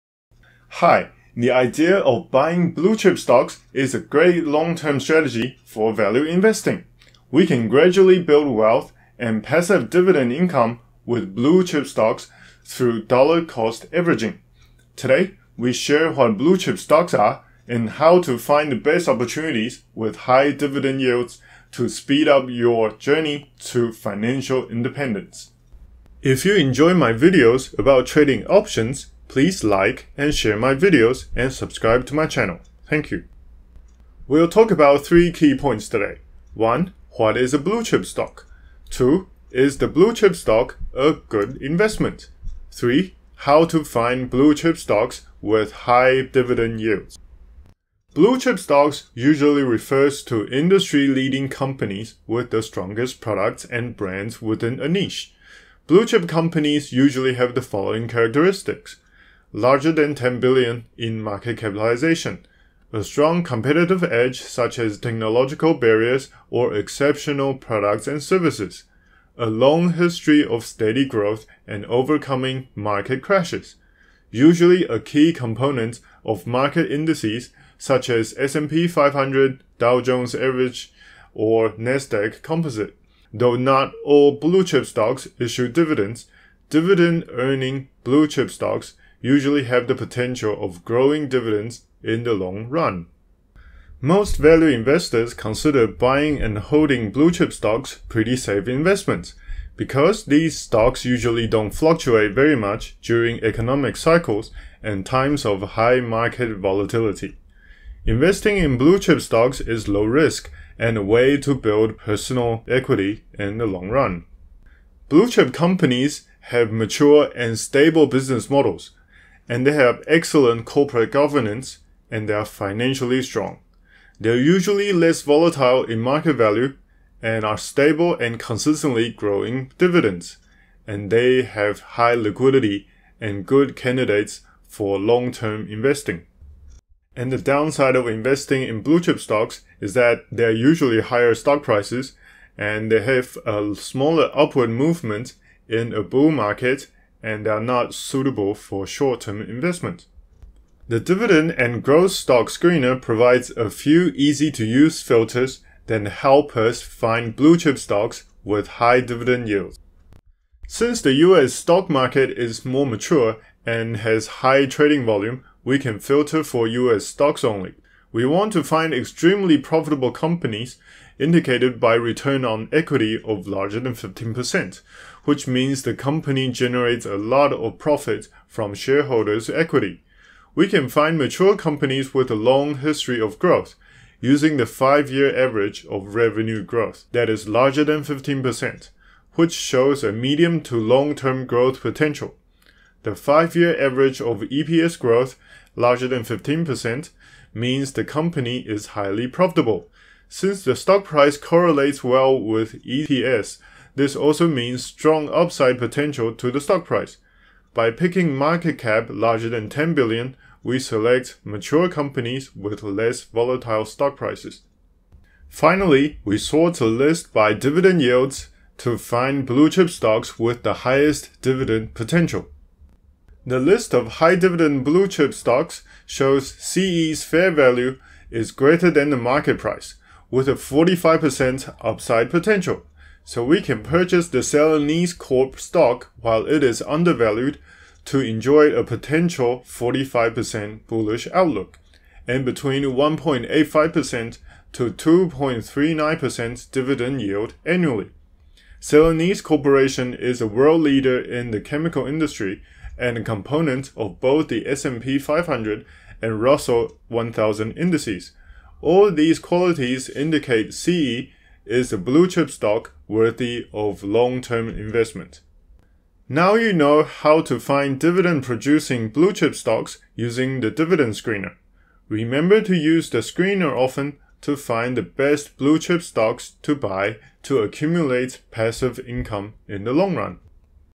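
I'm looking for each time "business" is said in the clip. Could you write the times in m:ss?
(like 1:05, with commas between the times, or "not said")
1:58.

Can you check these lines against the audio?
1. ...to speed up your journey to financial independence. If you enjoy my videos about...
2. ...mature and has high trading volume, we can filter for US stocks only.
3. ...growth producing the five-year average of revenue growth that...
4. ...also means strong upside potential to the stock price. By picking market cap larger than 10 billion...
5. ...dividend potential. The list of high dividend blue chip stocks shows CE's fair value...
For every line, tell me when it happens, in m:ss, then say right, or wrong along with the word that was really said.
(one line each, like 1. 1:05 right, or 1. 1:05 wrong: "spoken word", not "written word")
1. 0:21 right
2. 2:42 right
3. 3:03 wrong: "using", not "producing"
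4. 3:24 right
5. 3:41 right.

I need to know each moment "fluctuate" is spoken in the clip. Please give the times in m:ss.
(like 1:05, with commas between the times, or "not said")
1:41.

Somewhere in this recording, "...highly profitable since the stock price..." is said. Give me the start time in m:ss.
3:18.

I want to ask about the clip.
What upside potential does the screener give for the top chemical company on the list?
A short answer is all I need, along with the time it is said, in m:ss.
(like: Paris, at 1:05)
45%, at 3:50.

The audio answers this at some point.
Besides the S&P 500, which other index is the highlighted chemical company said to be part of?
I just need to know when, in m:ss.
4:16.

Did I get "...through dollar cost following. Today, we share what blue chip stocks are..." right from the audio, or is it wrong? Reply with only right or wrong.
wrong.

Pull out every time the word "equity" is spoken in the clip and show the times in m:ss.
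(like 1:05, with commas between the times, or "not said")
1:52, 2:52, 2:59.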